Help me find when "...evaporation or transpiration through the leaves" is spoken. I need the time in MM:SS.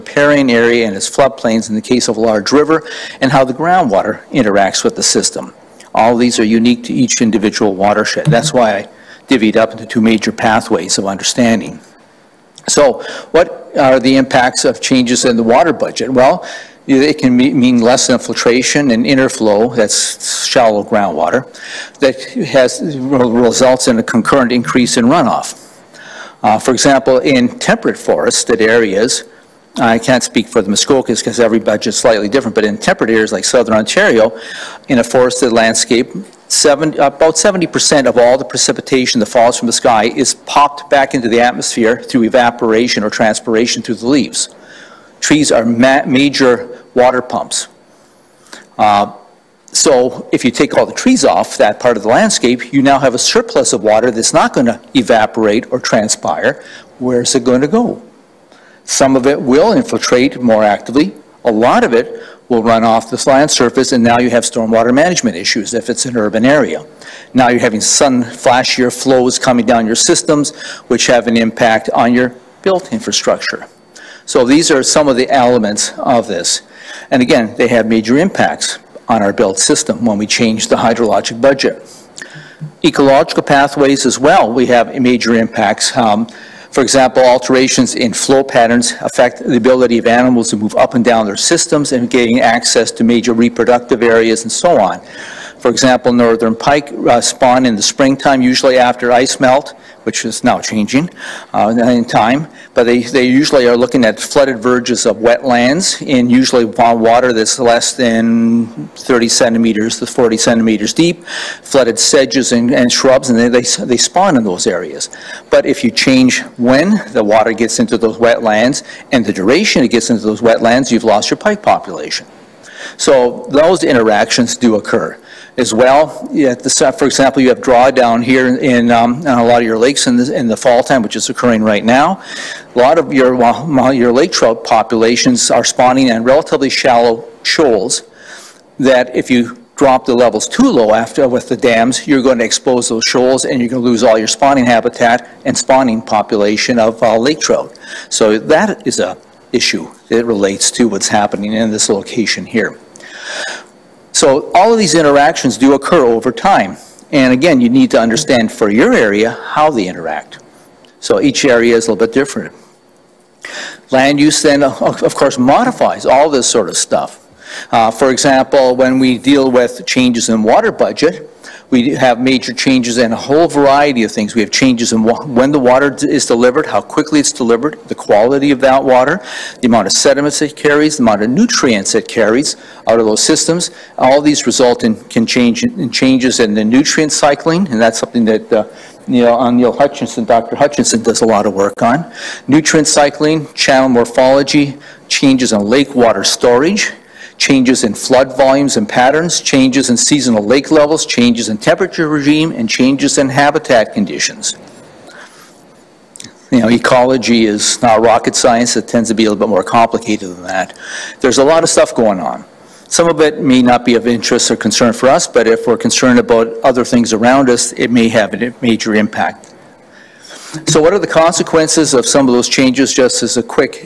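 00:42.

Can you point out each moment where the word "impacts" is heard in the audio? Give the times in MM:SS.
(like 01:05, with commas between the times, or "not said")
00:14, 01:11, 01:18, 01:25, 03:38.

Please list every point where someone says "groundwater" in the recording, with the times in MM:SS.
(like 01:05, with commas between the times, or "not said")
00:03, 00:20.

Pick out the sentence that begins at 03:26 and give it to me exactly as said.
You know, ecology is not rocket science.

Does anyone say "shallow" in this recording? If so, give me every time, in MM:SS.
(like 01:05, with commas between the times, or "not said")
00:20, 02:16.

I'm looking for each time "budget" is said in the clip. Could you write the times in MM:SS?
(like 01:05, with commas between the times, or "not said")
00:15, 00:31, 01:21, 02:50.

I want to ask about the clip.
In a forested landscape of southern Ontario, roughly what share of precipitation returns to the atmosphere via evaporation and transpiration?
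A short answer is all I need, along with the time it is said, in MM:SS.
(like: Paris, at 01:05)
70%, at 00:36.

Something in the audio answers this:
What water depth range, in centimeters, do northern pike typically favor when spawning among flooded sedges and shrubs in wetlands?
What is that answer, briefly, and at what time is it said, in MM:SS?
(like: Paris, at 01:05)
30 to 40 centimeters, at 01:48.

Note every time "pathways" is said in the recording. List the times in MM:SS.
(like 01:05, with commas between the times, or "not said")
00:10, 01:23.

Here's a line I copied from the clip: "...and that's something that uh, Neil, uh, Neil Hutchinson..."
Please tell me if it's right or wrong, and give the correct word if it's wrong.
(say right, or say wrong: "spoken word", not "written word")
right.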